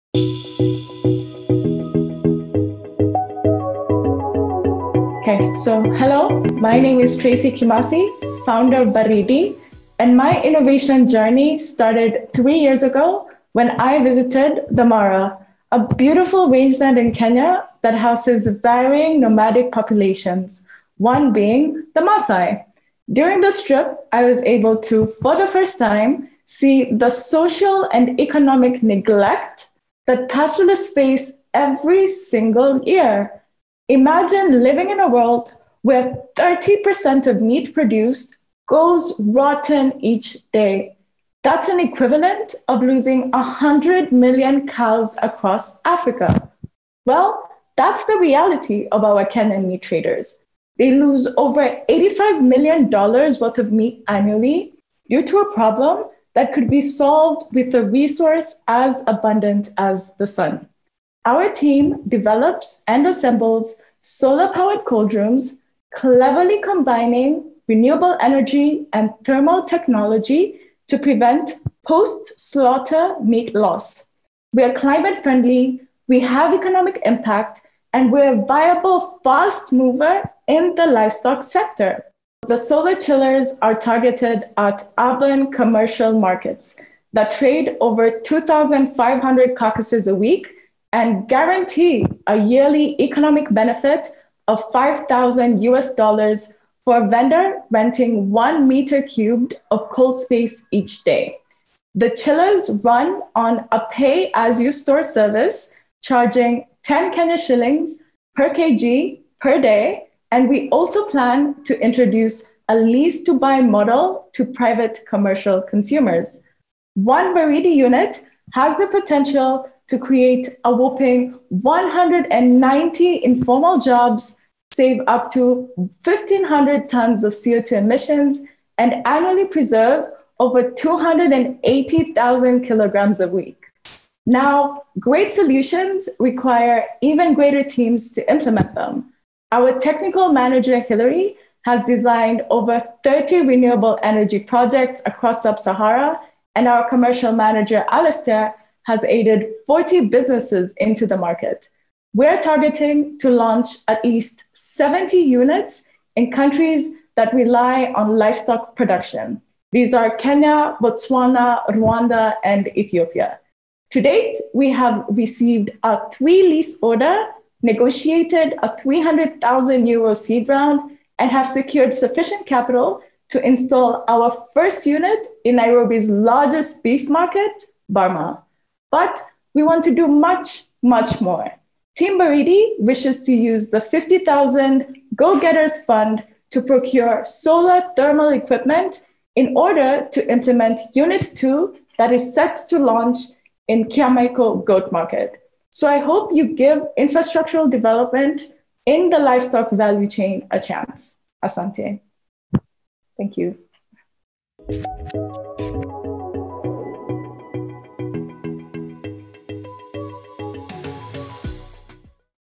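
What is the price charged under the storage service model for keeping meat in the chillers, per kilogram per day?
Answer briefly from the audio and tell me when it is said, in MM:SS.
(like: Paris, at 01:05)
10 Kenya shillings, at 01:46.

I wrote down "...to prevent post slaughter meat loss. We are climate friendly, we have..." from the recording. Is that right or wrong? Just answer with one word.
right.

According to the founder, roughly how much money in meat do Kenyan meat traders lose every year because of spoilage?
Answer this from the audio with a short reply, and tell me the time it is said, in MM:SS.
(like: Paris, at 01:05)
$85 million, at 00:51.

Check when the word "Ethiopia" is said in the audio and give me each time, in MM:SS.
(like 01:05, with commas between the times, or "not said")
02:42.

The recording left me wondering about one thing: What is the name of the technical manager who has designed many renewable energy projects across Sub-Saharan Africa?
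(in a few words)
Hillary.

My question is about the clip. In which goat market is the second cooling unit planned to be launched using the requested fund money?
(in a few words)
Kiamaiko Goat Market.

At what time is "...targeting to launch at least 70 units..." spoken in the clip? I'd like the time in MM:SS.
02:32.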